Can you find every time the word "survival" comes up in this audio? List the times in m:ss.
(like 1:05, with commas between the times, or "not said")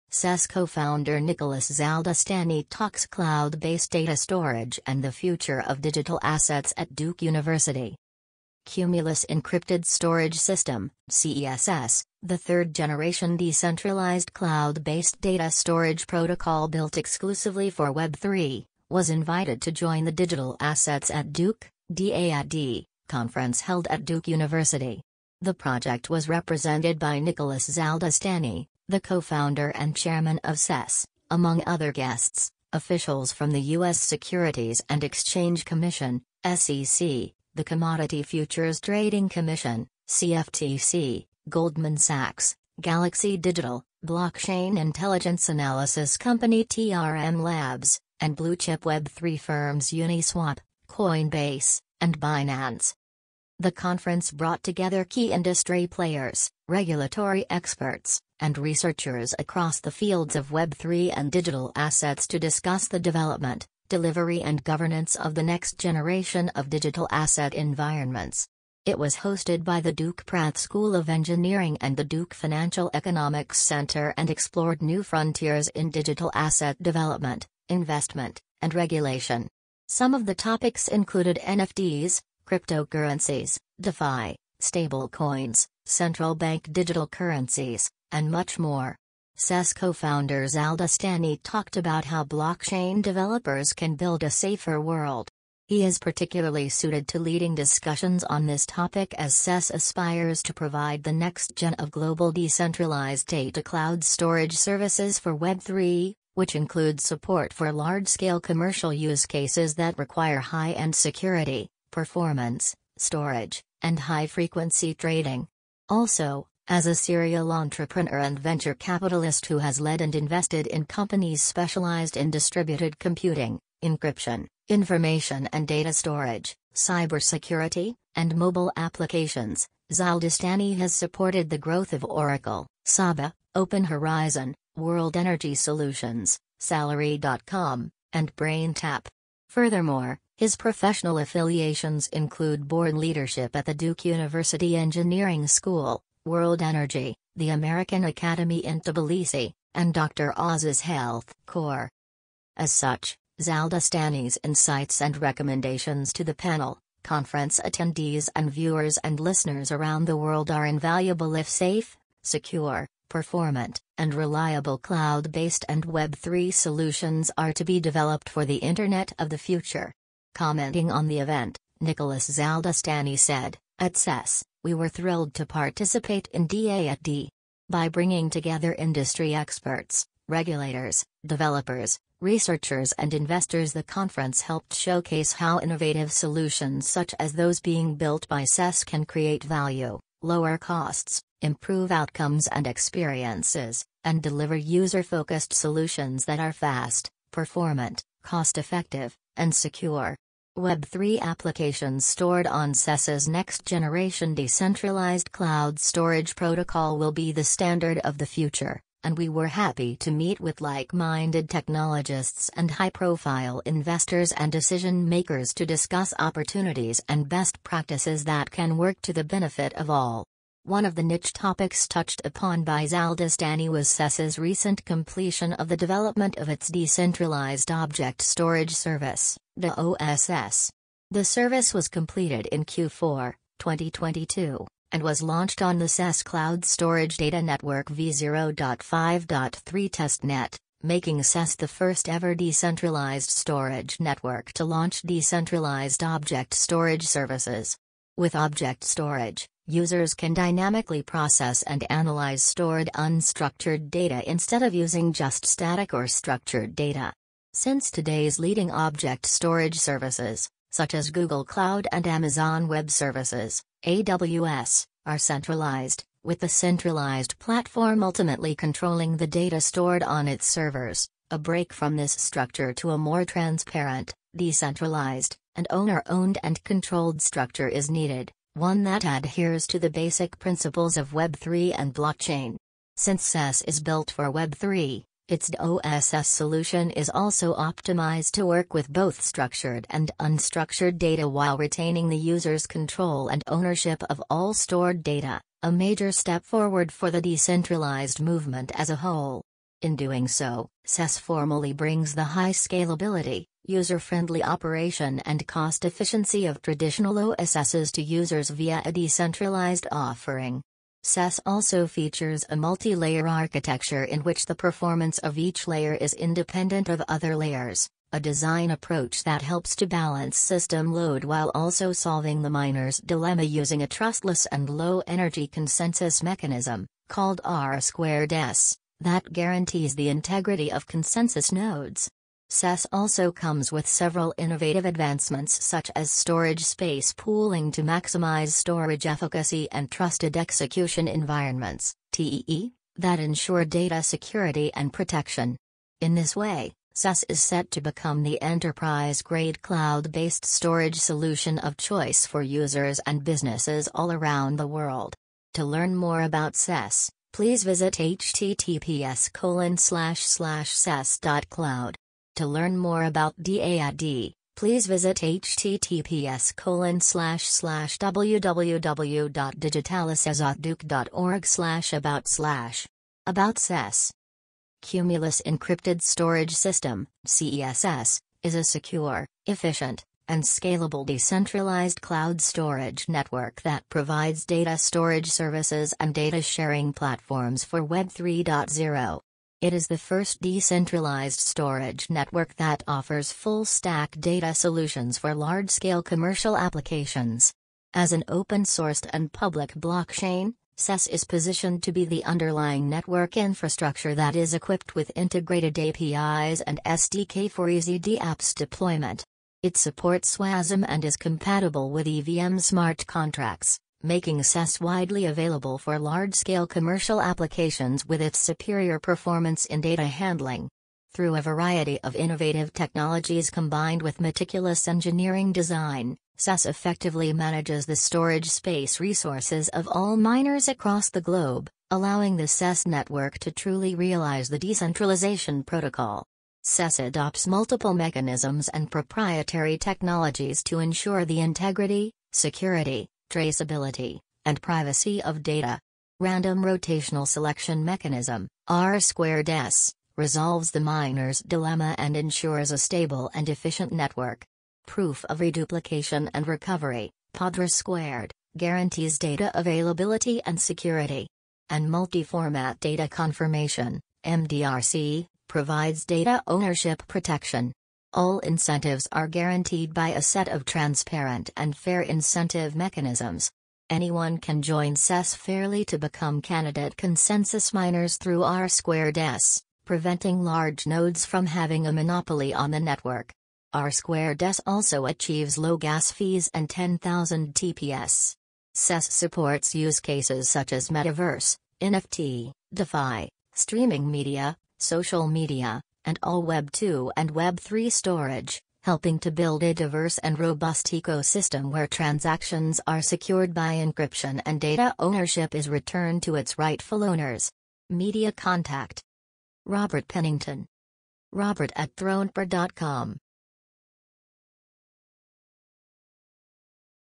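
not said.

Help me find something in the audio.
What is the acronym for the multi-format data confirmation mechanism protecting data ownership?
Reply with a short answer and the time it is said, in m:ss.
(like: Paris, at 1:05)
MDRC, at 7:44.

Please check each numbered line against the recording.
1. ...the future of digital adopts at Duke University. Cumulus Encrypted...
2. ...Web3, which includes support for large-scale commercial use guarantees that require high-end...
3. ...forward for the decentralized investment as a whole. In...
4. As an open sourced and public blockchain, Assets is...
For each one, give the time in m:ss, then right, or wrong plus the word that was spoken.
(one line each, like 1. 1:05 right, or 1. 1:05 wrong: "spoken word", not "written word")
1. 0:05 wrong: "assets", not "adopts"
2. 1:45 wrong: "cases", not "guarantees"
3. 4:56 wrong: "movement", not "investment"
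4. 6:37 wrong: "CESS", not "Assets".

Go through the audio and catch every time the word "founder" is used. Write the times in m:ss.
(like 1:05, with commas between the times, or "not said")
0:00, 0:28, 1:29.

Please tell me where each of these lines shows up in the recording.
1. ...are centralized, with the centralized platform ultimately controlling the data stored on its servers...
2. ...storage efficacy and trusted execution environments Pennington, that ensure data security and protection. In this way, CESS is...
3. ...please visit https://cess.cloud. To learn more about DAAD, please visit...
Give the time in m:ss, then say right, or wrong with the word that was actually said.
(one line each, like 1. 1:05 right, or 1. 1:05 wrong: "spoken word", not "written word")
1. 4:25 right
2. 5:38 wrong: "TEE", not "Pennington"
3. 5:57 right.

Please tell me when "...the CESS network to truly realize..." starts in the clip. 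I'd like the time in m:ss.
7:12.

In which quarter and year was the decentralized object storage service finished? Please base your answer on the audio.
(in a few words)
Q4 2022.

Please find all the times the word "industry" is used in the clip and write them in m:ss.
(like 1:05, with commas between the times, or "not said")
0:55, 2:58.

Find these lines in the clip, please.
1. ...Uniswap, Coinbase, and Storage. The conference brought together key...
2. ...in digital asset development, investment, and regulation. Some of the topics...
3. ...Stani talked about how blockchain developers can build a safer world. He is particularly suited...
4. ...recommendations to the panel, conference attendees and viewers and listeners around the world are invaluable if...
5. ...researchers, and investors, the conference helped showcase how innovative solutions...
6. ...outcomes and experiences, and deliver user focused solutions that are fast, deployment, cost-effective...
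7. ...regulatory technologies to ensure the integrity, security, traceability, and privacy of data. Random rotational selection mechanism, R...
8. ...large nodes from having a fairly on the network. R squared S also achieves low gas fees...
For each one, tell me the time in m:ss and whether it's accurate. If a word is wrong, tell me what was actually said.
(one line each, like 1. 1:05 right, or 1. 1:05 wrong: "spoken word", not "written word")
1. 0:49 wrong: "Binance", not "Storage"
2. 1:15 right
3. 1:30 right
4. 2:35 right
5. 3:02 right
6. 3:11 wrong: "performant", not "deployment"
7. 7:18 wrong: "proprietary", not "regulatory"
8. 8:00 wrong: "monopoly", not "fairly".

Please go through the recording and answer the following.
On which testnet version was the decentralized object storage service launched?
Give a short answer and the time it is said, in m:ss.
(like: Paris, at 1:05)
v0.5.3, at 3:57.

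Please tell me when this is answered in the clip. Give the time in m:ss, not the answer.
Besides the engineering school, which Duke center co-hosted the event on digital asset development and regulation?
1:12.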